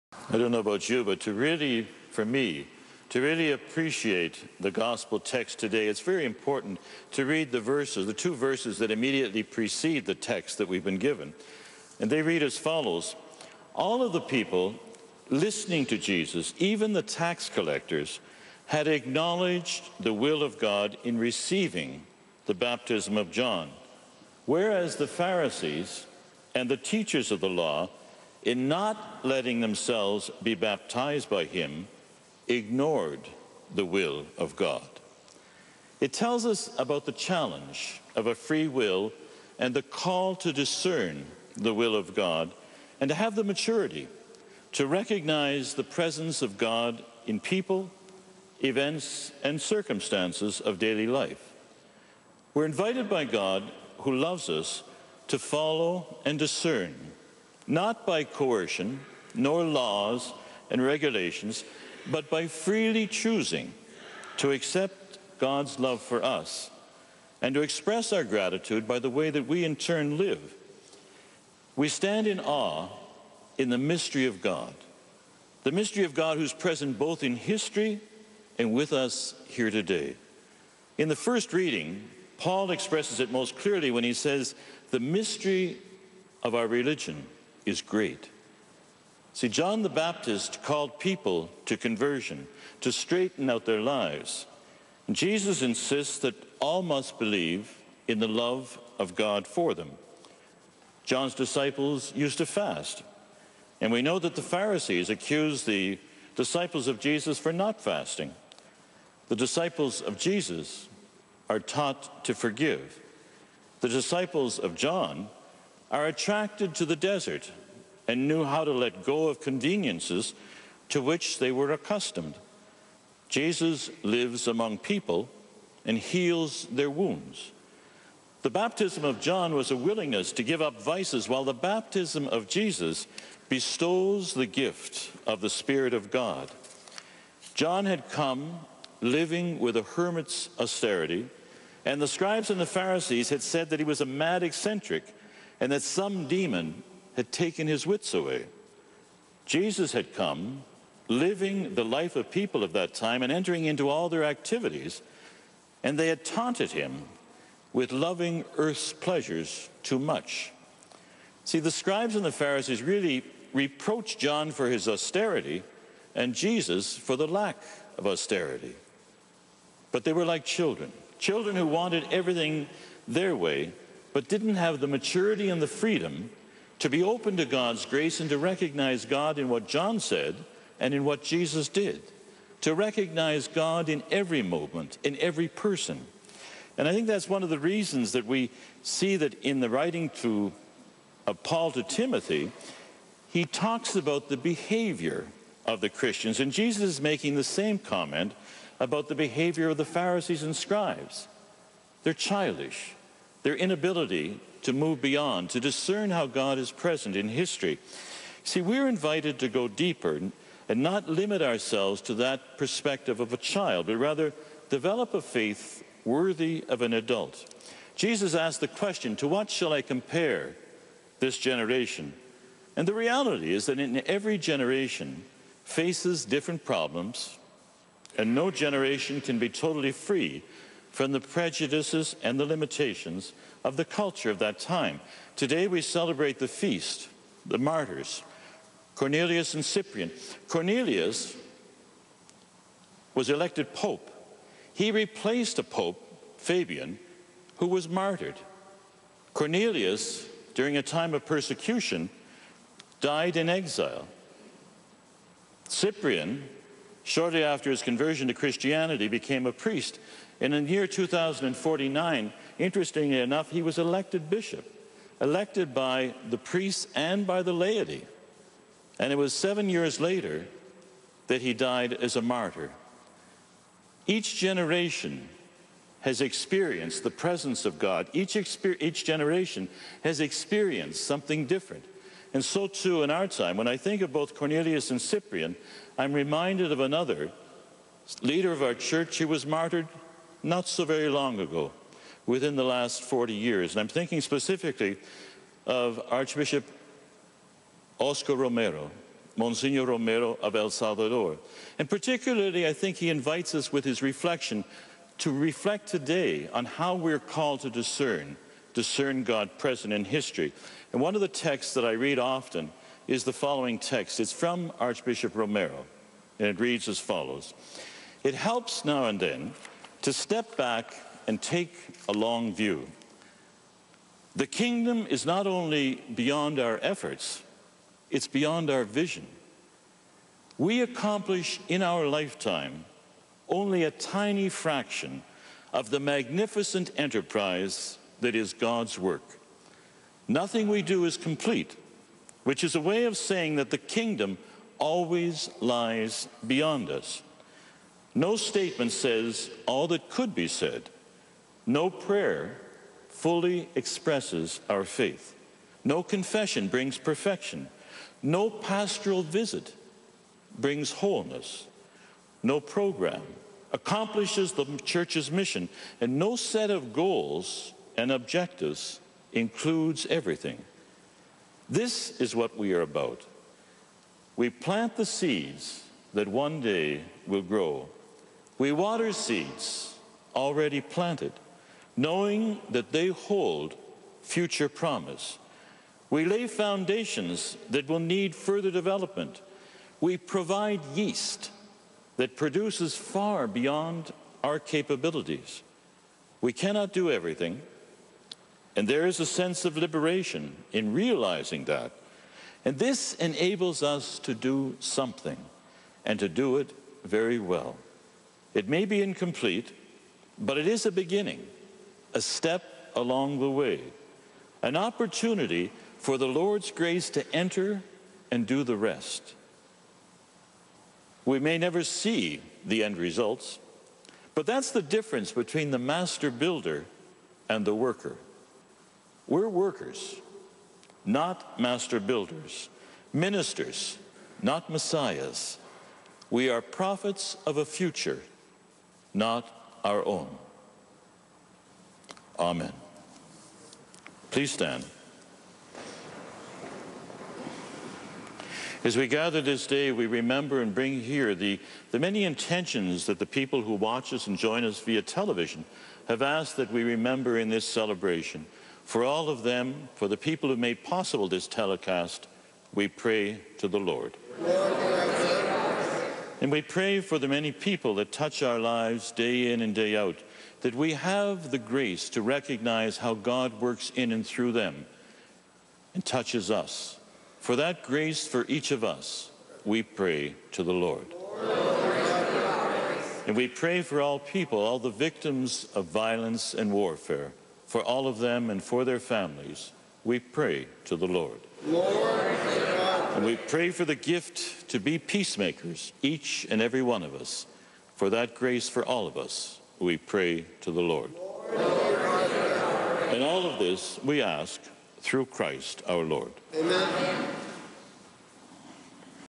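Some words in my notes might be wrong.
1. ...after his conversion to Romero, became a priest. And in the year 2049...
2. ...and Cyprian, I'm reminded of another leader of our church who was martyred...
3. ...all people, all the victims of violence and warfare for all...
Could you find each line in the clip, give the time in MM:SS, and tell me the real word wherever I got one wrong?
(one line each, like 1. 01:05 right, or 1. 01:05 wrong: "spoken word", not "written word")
1. 04:17 wrong: "Christianity", not "Romero"
2. 04:44 right
3. 08:04 right.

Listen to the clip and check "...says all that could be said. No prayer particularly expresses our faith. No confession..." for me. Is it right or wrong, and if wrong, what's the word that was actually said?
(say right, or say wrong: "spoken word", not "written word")
wrong: "fully", not "particularly".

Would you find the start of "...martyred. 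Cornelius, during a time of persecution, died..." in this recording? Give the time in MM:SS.
04:07.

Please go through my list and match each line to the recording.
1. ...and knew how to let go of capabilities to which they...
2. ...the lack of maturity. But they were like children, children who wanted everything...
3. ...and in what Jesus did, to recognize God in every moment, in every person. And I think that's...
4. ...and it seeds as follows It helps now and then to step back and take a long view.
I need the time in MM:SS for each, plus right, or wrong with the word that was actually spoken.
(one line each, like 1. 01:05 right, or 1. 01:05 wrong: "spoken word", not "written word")
1. 01:58 wrong: "conveniences", not "capabilities"
2. 02:47 wrong: "austerity", not "maturity"
3. 03:00 right
4. 05:16 wrong: "reads", not "seeds".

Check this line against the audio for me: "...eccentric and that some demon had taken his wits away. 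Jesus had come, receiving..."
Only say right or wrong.
wrong.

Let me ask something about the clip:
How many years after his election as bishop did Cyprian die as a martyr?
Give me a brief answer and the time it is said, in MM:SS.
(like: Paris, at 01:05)
7, at 04:29.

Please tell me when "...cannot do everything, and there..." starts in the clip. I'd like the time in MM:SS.
06:36.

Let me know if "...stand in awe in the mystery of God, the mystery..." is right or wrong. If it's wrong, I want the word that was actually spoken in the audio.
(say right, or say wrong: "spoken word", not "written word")
right.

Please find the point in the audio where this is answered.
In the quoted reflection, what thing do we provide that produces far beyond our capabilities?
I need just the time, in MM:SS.
06:30.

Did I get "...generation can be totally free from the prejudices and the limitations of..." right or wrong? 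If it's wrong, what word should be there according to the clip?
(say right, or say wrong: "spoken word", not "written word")
right.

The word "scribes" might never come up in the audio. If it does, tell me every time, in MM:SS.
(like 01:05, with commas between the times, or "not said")
02:22, 02:41, 03:20.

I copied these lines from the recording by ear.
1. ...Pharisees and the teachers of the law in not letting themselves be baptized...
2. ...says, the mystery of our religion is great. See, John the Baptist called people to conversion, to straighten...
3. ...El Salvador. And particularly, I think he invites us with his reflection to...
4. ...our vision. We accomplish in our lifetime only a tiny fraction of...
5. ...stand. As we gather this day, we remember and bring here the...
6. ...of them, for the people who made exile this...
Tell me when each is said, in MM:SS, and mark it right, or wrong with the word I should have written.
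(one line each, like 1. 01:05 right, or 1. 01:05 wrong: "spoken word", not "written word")
1. 00:25 right
2. 01:24 right
3. 05:00 right
4. 05:28 right
5. 07:24 right
6. 07:39 wrong: "possible", not "exile".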